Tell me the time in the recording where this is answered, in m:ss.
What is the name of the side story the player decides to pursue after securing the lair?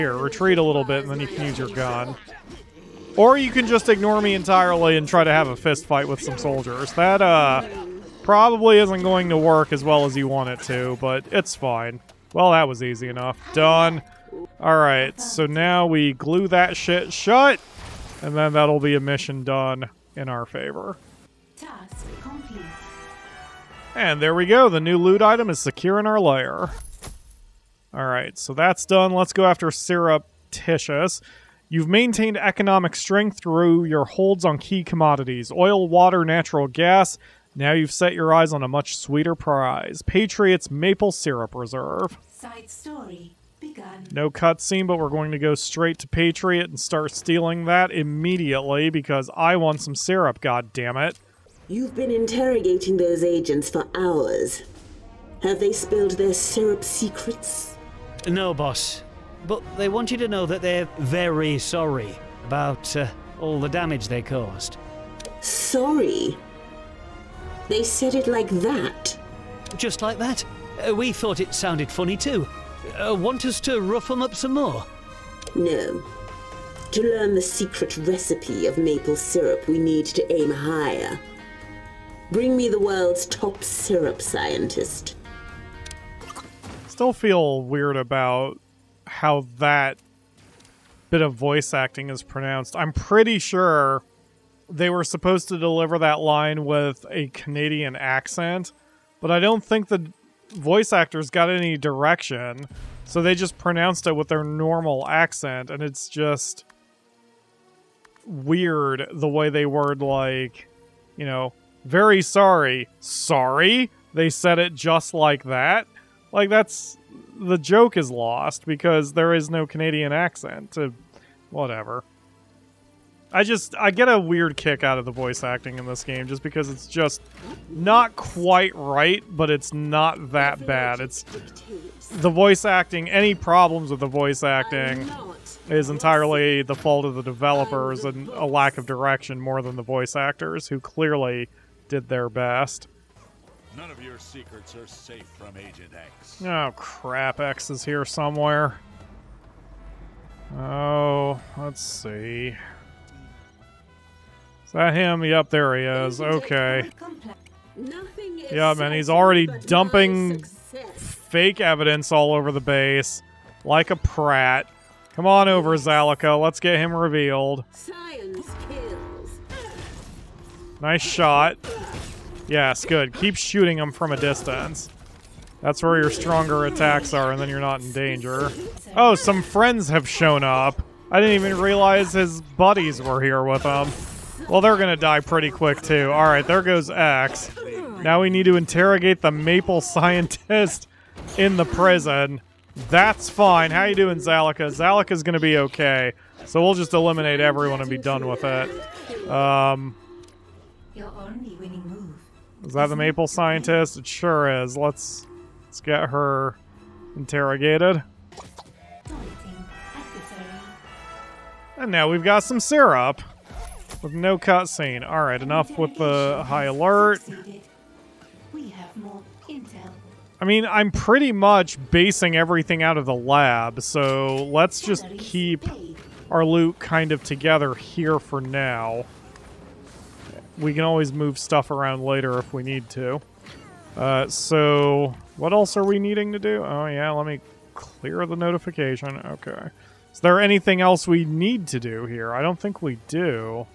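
0:29.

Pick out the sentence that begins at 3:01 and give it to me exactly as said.
I didn't even realize his buddies were here with him.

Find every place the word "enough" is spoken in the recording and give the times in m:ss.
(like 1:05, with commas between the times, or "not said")
0:13, 3:35.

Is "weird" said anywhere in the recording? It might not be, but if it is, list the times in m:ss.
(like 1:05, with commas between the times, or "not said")
1:27, 1:48, 2:04.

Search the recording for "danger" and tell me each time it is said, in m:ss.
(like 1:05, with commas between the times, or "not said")
2:57.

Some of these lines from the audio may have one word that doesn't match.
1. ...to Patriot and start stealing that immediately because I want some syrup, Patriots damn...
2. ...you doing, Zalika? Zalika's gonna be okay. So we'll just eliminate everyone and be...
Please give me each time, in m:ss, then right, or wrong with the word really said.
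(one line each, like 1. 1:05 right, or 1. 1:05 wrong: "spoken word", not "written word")
1. 0:45 wrong: "God", not "Patriots"
2. 3:13 right.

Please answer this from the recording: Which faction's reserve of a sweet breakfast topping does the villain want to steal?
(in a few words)
Patriot.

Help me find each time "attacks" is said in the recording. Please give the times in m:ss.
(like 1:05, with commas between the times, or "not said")
2:56.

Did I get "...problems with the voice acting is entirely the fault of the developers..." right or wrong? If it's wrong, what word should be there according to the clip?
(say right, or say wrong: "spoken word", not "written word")
right.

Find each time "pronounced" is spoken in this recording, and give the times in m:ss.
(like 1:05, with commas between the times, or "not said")
1:32, 1:43.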